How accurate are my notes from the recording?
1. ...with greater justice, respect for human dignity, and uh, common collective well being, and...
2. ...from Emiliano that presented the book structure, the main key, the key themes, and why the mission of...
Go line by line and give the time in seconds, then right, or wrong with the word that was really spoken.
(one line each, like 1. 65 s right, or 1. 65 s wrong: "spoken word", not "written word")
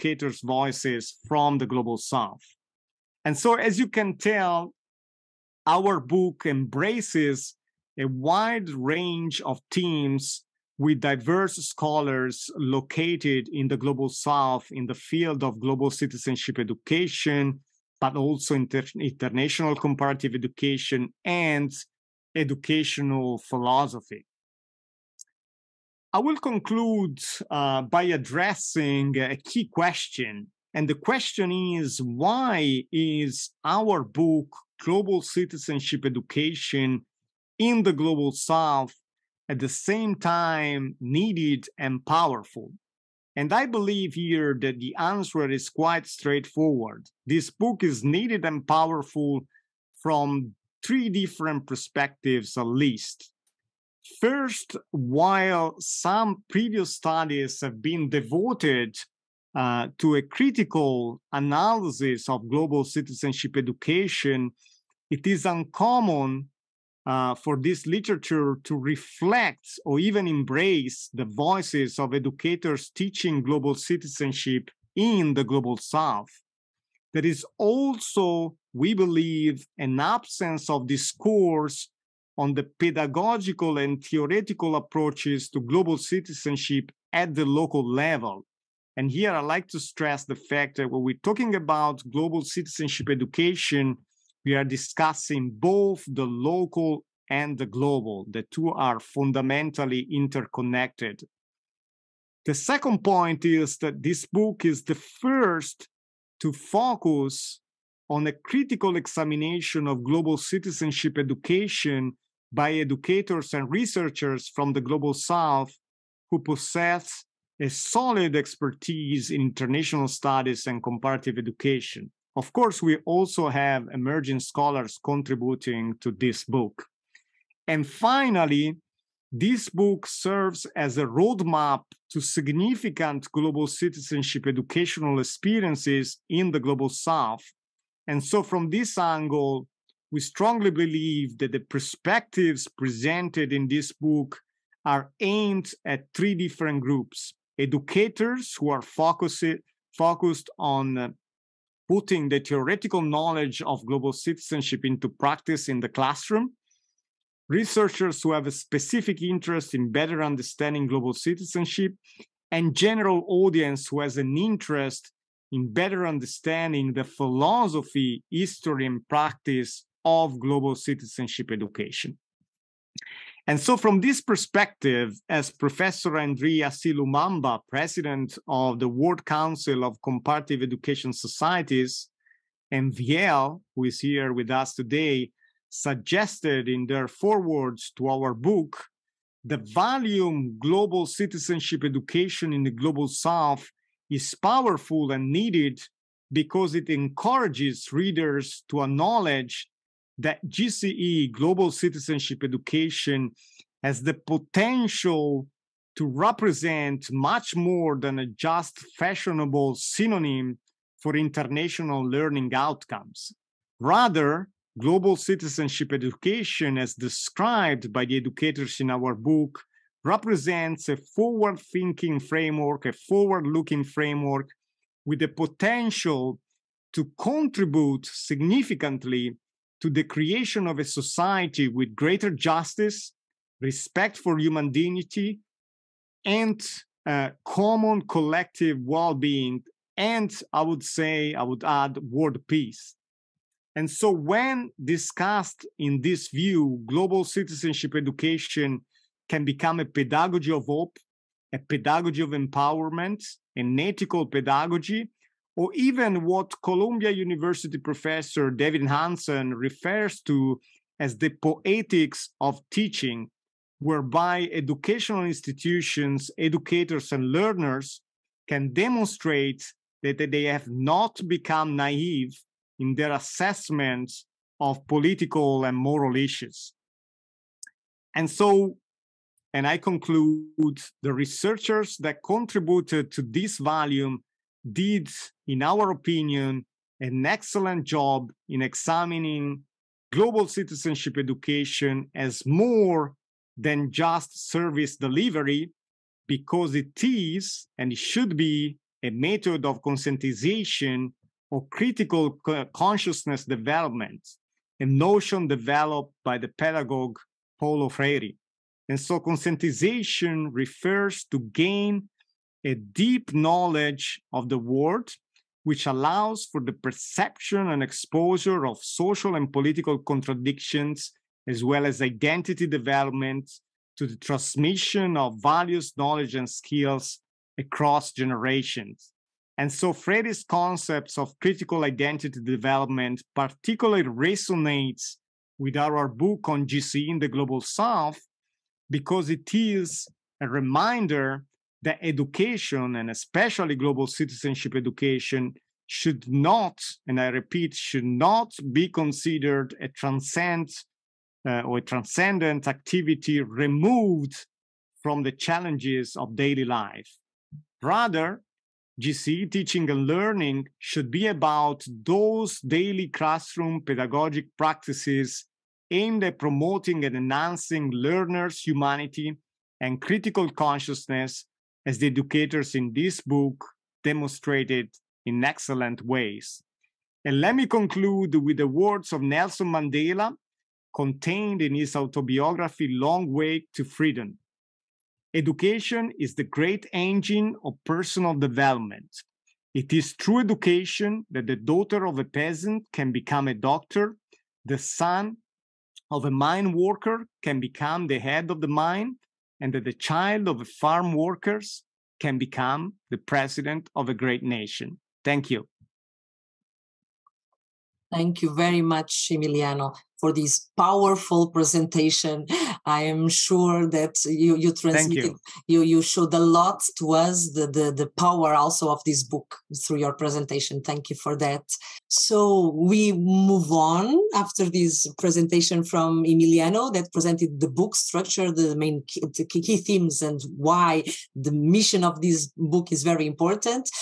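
1. 231 s right
2. 425 s right.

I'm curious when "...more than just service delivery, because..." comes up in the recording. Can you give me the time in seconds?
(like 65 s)
292 s.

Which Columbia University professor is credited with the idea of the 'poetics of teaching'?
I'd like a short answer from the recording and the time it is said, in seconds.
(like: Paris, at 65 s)
David Hansen, at 258 s.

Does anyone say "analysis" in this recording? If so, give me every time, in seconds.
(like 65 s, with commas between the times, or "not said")
61 s.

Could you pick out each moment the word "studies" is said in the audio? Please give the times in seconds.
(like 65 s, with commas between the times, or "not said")
56 s, 120 s.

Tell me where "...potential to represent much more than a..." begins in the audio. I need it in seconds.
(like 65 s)
204 s.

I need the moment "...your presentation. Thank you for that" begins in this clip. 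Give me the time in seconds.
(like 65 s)
419 s.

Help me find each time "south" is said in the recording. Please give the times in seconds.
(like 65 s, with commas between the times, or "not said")
1 s, 14 s, 38 s, 75 s, 115 s, 136 s, 193 s, 337 s.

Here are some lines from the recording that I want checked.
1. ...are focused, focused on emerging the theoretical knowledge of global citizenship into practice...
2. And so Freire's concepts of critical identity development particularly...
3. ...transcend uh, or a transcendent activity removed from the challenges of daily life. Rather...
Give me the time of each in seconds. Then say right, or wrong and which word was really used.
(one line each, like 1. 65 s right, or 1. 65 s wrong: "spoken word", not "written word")
1. 148 s wrong: "putting", not "emerging"
2. 329 s right
3. 349 s right.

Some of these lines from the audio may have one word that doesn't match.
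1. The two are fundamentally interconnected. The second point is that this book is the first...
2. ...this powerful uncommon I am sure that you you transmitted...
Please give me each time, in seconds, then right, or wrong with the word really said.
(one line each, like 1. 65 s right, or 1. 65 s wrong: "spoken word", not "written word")
1. 98 s right
2. 410 s wrong: "presentation", not "uncommon".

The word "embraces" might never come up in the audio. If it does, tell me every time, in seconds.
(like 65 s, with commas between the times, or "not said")
6 s, 70 s.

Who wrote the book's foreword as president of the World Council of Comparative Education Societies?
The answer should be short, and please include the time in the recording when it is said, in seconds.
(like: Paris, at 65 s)
N'Dri Assié-Lumumba, at 176 s.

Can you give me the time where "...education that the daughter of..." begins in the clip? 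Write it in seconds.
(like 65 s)
390 s.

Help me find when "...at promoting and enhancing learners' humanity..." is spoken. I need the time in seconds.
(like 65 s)
366 s.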